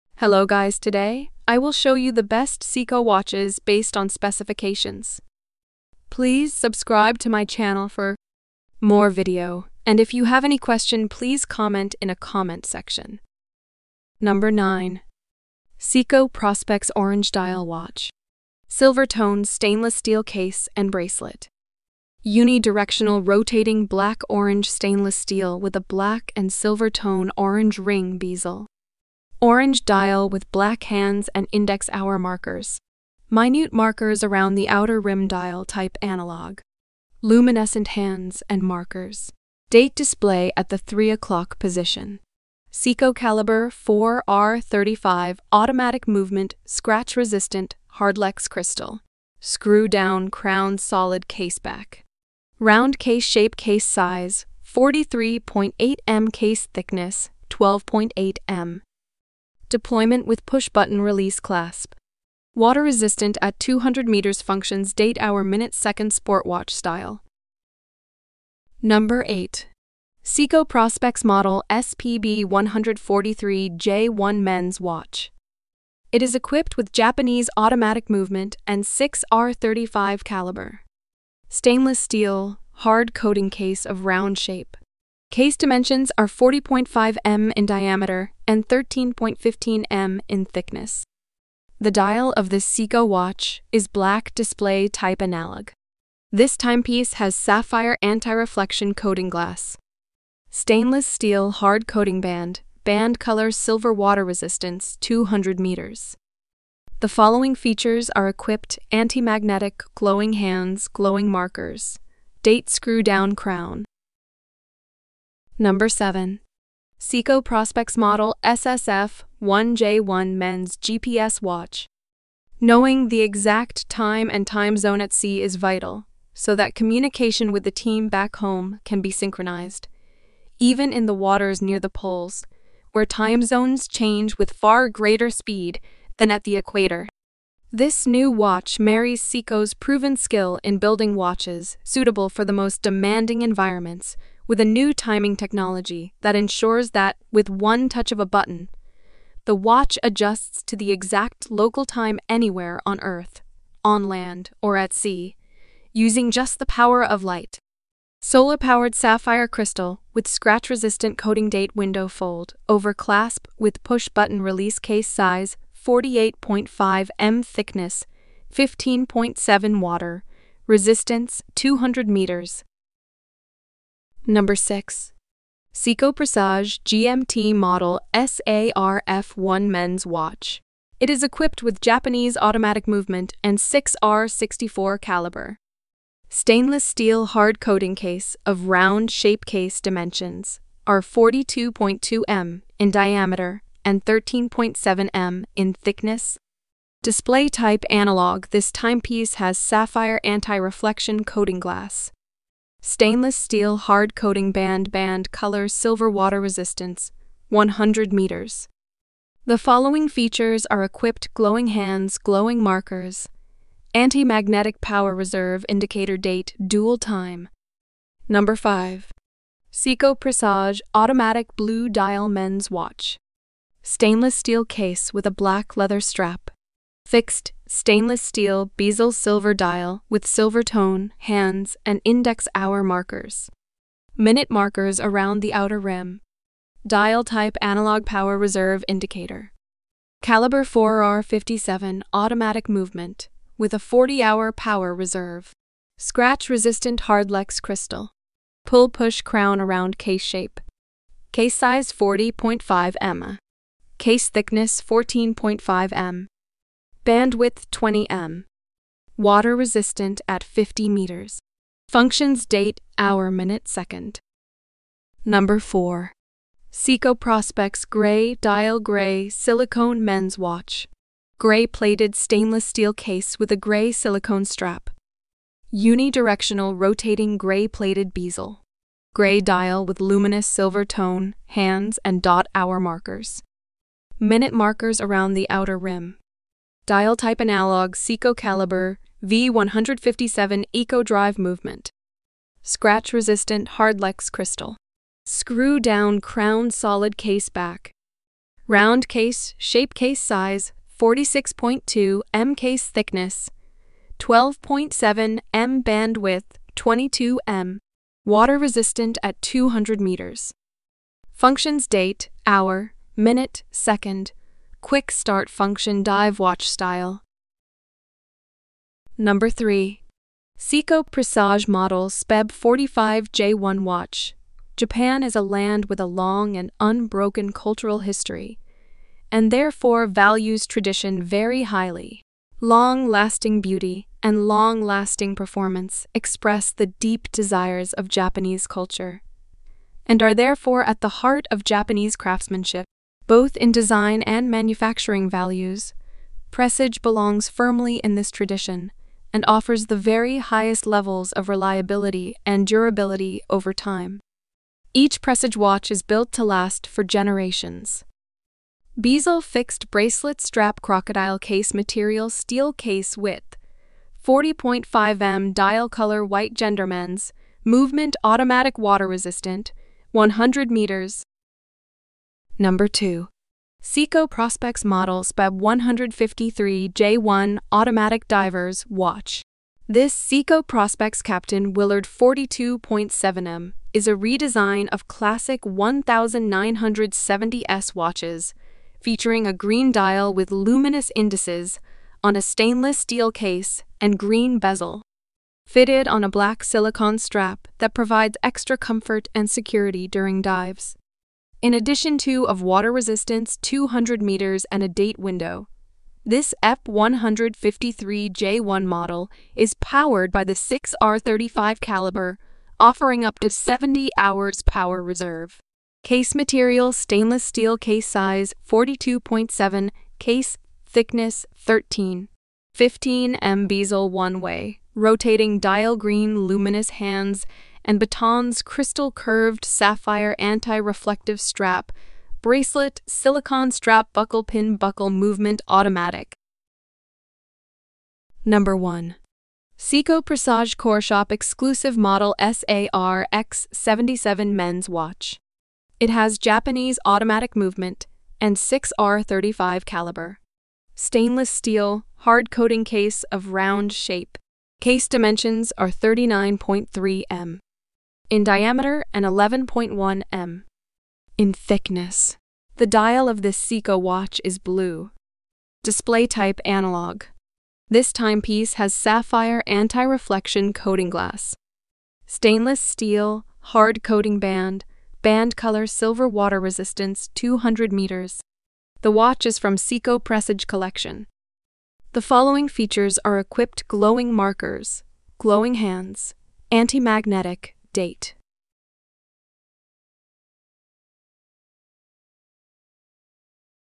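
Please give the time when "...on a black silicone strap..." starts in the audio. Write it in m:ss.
6:36.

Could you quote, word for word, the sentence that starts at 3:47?
Fixed stainless steel bezel silver dial with silver tone, hands, and index hour markers.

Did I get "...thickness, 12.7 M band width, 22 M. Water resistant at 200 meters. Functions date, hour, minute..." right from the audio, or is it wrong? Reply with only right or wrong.
right.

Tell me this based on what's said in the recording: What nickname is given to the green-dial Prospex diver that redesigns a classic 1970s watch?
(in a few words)
Captain Willard.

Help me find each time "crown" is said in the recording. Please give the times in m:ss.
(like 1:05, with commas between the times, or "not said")
0:50, 1:53, 4:09, 4:56.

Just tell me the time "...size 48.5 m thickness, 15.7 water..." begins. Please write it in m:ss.
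2:45.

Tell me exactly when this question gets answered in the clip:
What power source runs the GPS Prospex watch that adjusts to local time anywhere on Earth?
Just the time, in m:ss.
2:36.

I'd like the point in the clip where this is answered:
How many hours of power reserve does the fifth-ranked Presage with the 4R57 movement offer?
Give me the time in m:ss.
4:03.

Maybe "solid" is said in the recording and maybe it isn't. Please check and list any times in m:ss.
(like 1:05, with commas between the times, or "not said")
0:50, 4:56.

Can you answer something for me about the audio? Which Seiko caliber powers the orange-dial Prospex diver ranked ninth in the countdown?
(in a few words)
4R35.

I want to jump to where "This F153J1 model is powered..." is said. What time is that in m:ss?
6:46.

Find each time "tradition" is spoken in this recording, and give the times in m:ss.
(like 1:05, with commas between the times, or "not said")
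5:30, 5:48.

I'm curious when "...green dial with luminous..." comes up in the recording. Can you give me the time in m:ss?
6:29.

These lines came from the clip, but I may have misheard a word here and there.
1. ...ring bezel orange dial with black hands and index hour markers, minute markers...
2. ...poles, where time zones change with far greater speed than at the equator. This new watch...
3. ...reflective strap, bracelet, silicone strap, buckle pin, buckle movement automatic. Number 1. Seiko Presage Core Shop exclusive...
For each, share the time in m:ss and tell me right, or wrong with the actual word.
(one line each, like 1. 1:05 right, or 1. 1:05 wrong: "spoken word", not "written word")
1. 0:27 right
2. 2:11 right
3. 7:10 right.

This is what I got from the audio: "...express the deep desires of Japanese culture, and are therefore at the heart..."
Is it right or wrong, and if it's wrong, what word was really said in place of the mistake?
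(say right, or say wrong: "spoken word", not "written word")
right.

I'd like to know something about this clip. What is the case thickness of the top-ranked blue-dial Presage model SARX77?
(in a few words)
11.1 mm.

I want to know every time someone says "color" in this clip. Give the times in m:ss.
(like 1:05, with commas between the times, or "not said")
1:43, 3:25, 6:05, 7:55.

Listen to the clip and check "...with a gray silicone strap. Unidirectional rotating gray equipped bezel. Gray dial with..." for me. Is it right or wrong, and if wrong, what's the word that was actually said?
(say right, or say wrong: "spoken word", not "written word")
wrong: "plated", not "equipped".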